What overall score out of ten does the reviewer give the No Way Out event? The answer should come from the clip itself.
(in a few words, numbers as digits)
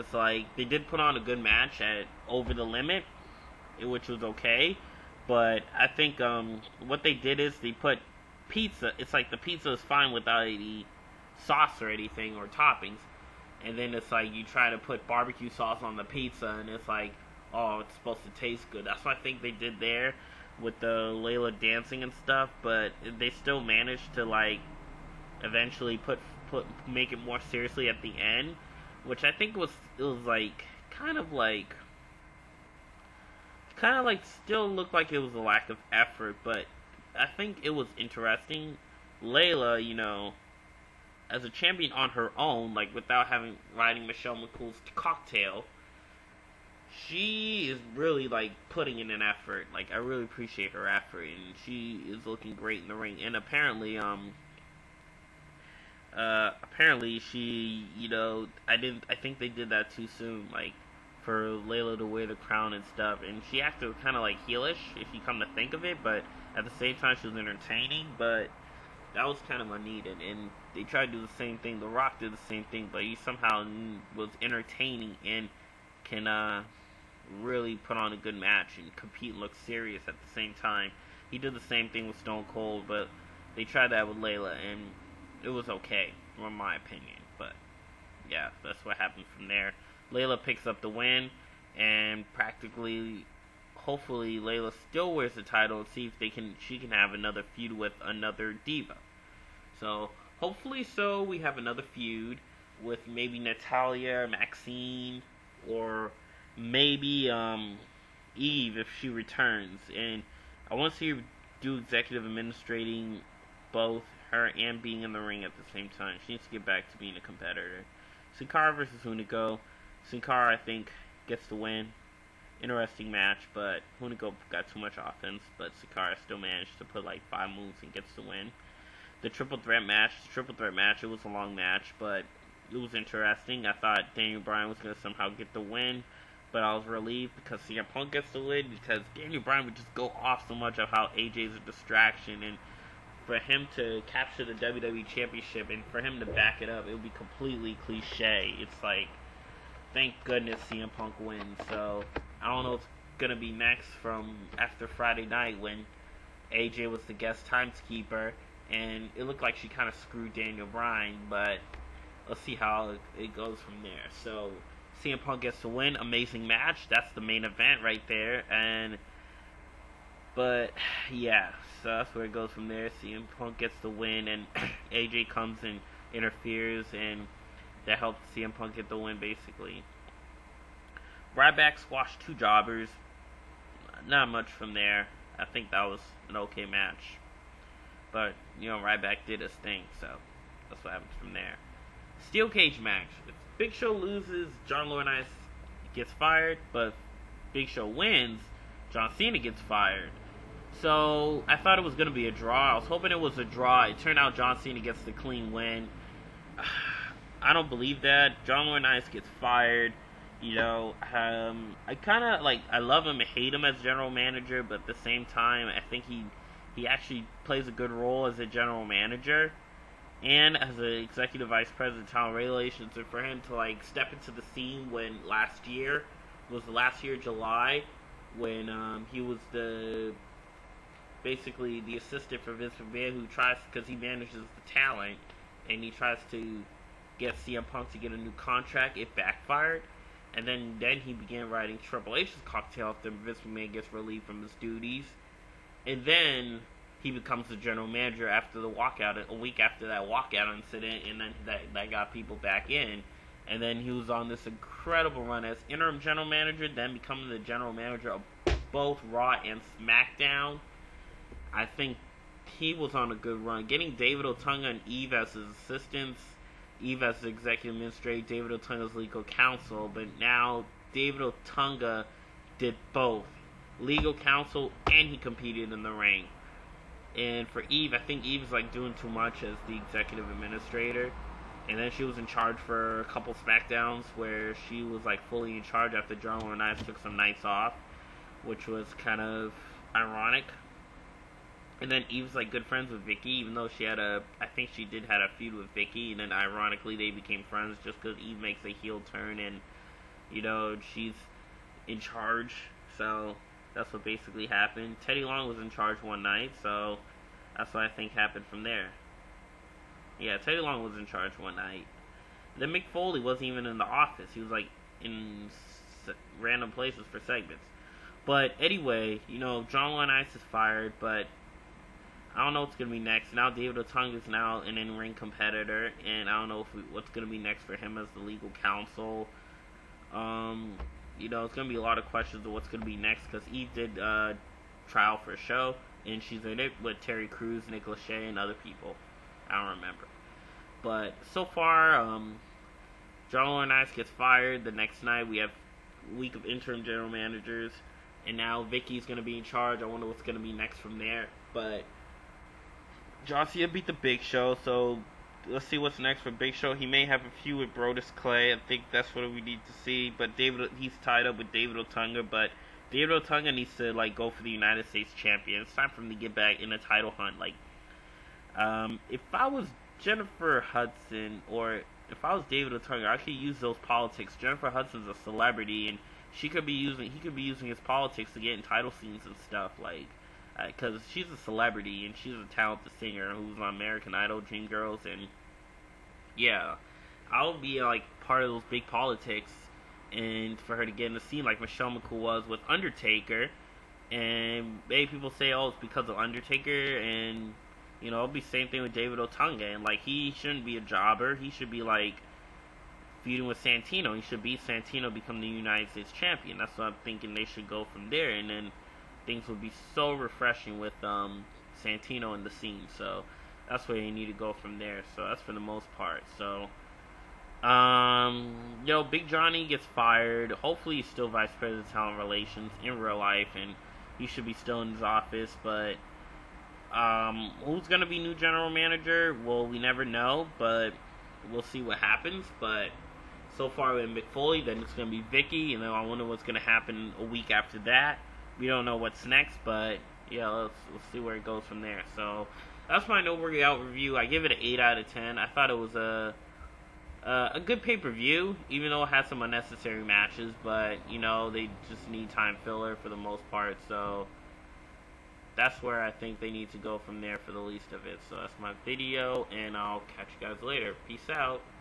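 8.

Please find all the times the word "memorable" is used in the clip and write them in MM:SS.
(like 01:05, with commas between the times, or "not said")
not said.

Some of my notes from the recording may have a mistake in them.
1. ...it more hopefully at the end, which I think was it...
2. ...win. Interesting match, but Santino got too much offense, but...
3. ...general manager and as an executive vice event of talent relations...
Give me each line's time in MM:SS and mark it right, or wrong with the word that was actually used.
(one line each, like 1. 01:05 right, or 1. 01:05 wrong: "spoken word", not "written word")
1. 00:27 wrong: "seriously", not "hopefully"
2. 02:01 wrong: "Hunico", not "Santino"
3. 03:38 wrong: "president", not "event".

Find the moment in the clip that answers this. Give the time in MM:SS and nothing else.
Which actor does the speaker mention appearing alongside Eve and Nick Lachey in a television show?
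05:37.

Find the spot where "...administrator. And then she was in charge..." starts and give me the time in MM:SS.
04:40.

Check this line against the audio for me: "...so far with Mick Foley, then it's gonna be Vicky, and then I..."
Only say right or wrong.
right.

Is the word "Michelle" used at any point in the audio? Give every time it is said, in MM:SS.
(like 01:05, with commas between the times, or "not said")
00:44, 06:31.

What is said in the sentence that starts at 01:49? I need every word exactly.
And I want to see her do executive administrating both her and being in the ring at the same time.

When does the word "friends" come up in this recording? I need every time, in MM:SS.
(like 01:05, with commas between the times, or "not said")
04:52, 04:57.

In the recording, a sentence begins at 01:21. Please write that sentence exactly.
He did the same thing with Stone Cold, but they tried that with Layla, and it was okay, from my opinion.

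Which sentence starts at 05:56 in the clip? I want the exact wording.
He may have a few with Brodus Clay.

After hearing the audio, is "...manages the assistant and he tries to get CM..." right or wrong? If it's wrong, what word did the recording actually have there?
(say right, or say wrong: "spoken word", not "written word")
wrong: "talent", not "assistant".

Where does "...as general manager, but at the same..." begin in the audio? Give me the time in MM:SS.
03:33.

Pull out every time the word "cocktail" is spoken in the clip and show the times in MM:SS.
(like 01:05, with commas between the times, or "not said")
00:44, 04:02.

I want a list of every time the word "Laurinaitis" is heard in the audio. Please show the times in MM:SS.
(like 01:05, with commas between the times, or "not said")
03:14, 03:28, 05:43.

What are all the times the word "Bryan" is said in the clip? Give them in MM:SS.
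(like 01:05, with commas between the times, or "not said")
02:14, 02:19, 02:40.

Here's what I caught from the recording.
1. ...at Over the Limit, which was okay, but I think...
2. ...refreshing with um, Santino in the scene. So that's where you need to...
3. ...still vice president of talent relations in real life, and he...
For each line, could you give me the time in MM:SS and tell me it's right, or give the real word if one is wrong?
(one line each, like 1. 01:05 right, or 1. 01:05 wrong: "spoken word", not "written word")
1. 00:01 right
2. 06:50 right
3. 07:01 right.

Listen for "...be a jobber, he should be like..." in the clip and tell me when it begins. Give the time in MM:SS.
06:40.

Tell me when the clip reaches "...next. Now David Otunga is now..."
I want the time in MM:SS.
05:22.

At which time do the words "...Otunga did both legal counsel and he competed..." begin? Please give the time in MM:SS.
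04:31.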